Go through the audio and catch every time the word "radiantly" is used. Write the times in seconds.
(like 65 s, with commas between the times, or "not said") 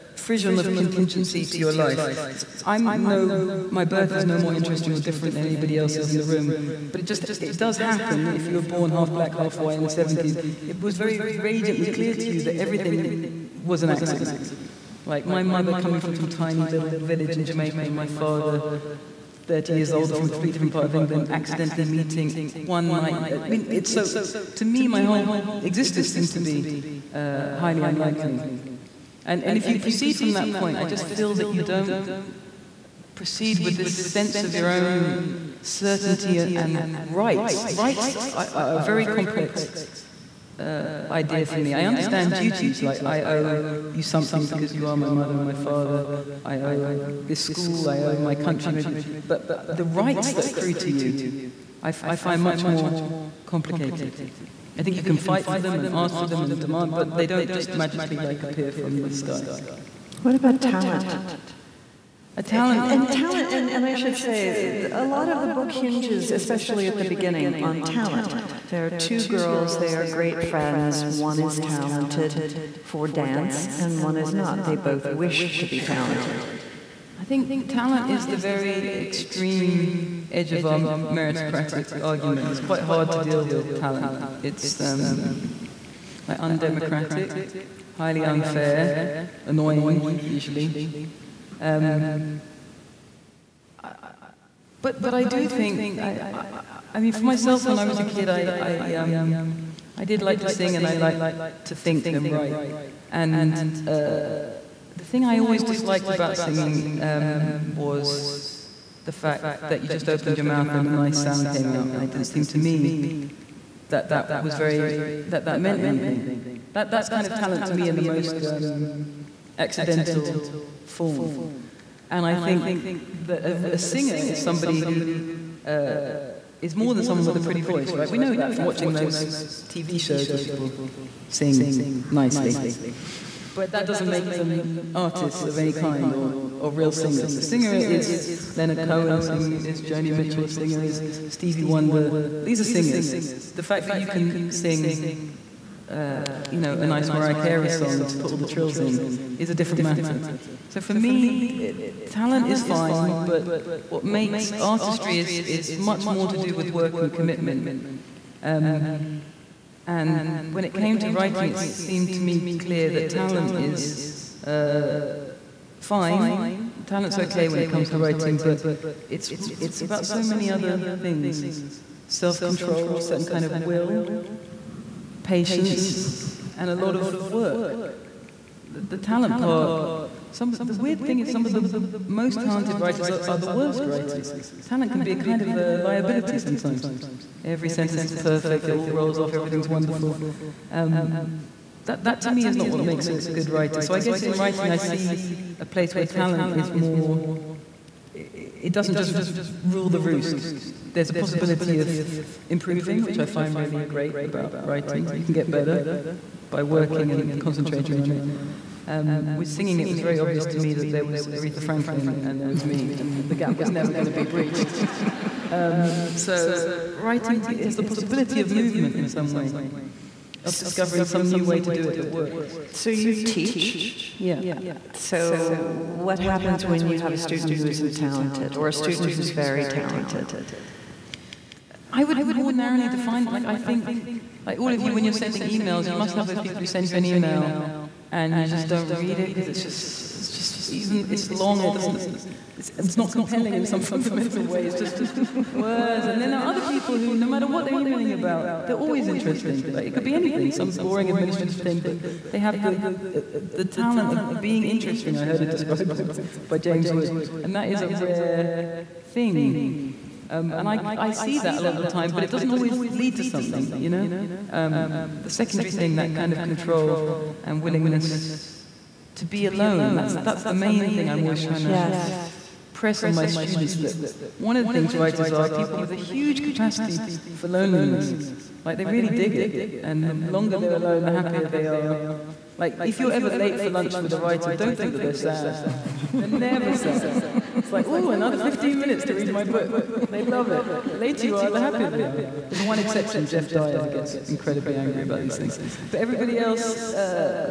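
11 s.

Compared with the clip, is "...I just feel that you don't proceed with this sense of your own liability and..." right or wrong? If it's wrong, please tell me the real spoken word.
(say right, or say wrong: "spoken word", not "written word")
wrong: "certainty", not "liability".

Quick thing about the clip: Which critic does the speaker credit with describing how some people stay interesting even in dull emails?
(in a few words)
James Wood.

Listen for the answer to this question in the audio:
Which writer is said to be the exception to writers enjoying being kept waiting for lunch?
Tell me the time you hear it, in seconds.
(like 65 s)
293 s.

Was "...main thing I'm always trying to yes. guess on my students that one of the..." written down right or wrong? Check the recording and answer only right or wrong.
wrong.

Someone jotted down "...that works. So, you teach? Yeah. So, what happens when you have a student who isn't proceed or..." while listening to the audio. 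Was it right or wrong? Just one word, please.
wrong.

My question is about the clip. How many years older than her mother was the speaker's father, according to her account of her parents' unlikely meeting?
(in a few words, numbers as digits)
30.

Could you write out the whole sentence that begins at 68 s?
There are two girls, they are great friends.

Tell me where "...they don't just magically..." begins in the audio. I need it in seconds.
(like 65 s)
57 s.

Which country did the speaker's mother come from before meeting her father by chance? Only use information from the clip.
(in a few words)
Jamaica.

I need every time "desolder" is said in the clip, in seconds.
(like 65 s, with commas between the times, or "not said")
not said.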